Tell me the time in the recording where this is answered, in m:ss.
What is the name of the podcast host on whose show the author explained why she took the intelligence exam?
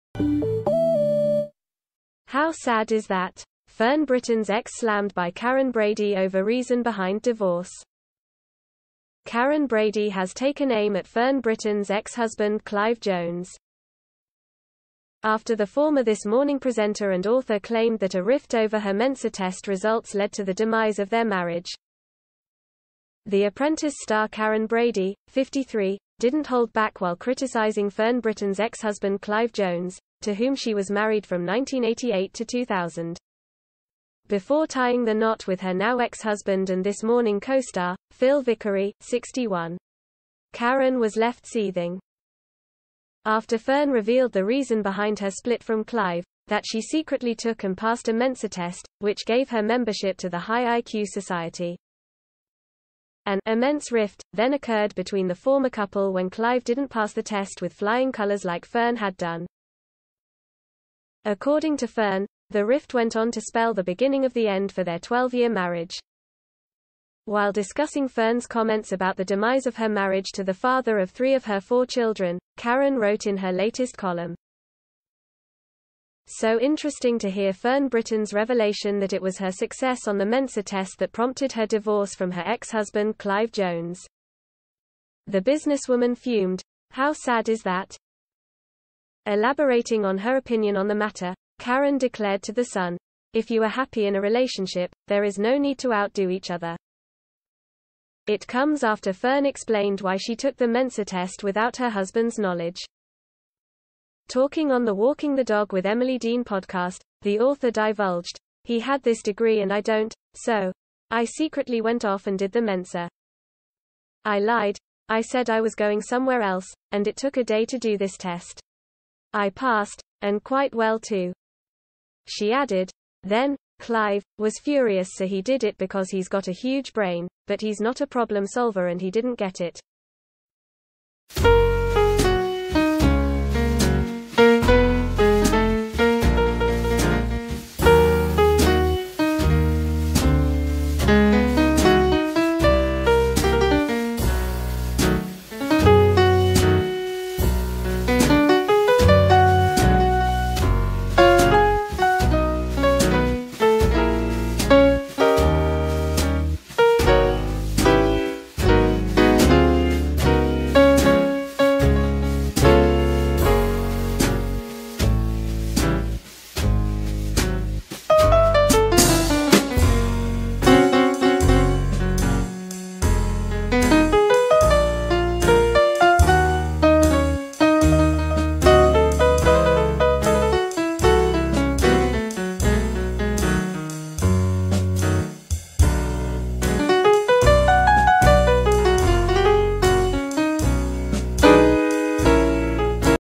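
1:45.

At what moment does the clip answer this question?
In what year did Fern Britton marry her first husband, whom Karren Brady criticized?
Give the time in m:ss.
0:31.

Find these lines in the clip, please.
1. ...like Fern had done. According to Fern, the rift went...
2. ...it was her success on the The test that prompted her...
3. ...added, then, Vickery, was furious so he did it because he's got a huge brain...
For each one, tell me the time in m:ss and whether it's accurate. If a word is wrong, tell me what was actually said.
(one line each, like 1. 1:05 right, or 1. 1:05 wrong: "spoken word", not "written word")
1. 0:58 right
2. 1:19 wrong: "Mensa", not "The"
3. 2:02 wrong: "Clive", not "Vickery".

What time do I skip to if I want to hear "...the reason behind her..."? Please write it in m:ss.
0:44.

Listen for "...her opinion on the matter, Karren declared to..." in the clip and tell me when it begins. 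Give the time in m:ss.
1:30.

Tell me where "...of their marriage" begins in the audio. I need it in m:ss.
0:20.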